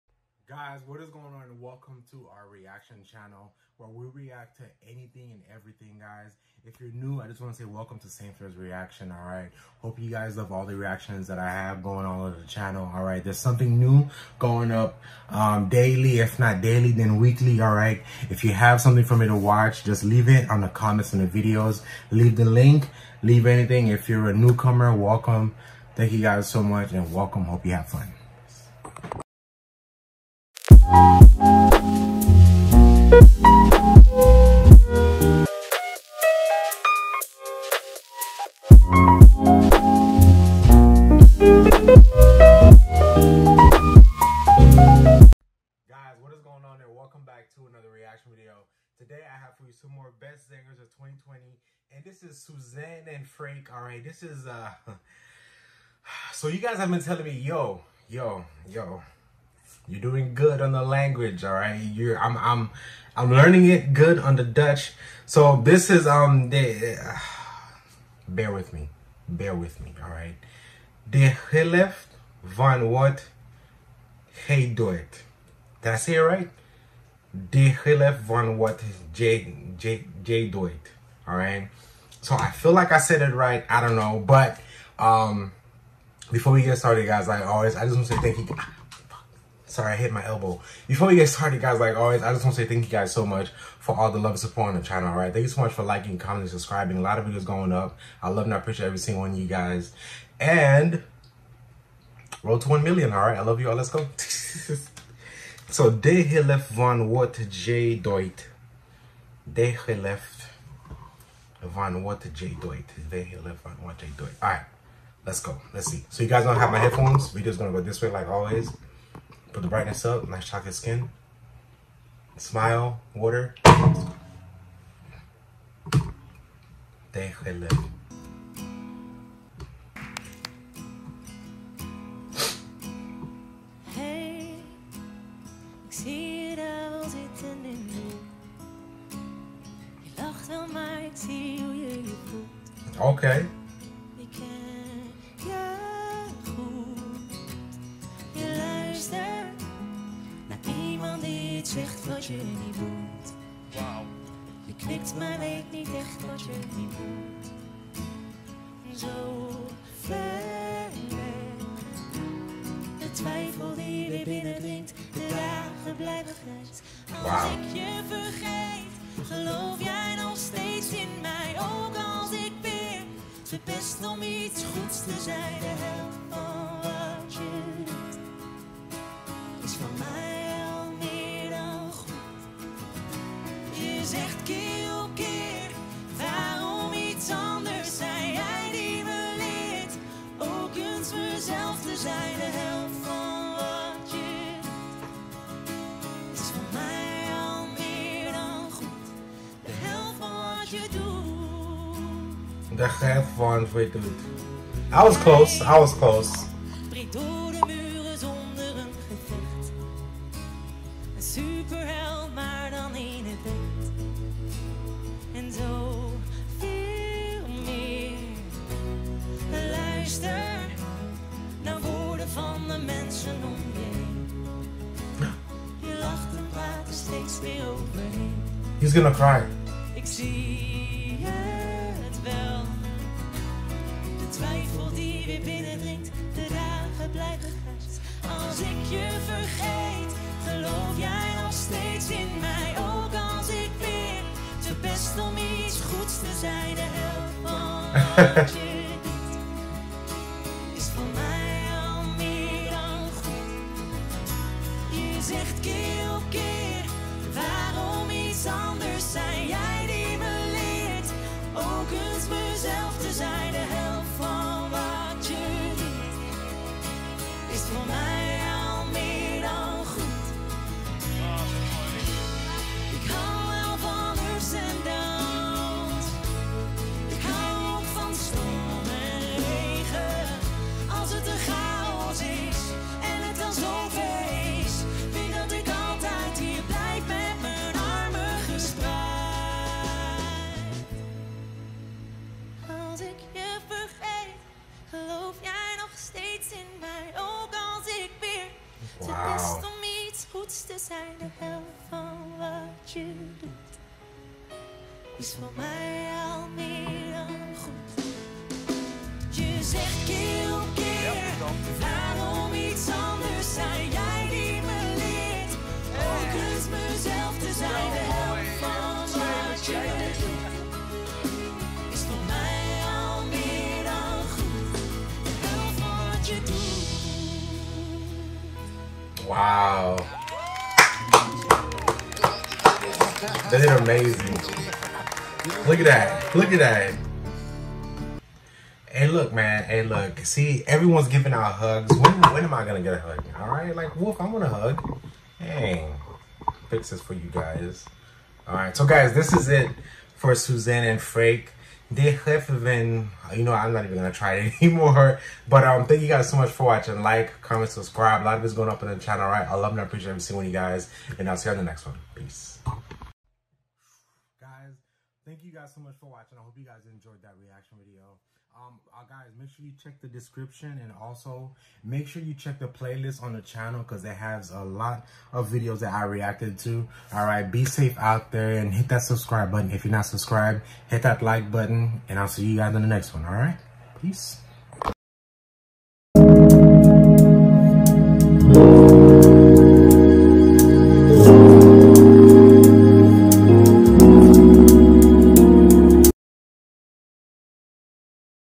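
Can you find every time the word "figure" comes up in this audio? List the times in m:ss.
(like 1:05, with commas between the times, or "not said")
not said.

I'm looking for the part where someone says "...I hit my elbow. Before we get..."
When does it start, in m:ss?
1:29.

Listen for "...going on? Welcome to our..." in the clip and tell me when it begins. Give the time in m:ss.
0:01.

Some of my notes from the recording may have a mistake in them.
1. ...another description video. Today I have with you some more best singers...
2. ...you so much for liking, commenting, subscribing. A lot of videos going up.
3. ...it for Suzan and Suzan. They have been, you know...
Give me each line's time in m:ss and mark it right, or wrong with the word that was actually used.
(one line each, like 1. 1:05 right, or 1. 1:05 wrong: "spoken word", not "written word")
1. 0:47 wrong: "reaction", not "description"
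2. 1:35 right
3. 5:49 wrong: "Frank", not "Suzan".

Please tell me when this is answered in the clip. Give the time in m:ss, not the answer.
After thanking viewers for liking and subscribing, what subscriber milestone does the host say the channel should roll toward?
1:42.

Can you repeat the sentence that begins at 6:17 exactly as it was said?
All right, be safe out there and hit that subscribe button.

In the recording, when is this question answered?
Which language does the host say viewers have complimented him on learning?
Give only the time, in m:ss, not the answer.
1:04.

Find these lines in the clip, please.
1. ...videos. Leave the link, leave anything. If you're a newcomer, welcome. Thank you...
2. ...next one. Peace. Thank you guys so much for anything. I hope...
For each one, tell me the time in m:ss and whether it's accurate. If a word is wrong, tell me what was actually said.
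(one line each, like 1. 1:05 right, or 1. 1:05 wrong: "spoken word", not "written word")
1. 0:21 right
2. 6:01 wrong: "watching", not "anything".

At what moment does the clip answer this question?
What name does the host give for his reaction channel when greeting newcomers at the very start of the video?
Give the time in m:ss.
0:08.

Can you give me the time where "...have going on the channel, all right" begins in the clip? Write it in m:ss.
0:11.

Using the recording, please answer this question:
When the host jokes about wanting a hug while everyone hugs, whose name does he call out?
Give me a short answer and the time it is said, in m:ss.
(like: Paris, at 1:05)
Wolf, at 5:43.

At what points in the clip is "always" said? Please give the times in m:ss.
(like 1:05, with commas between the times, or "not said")
1:27, 1:31, 1:58.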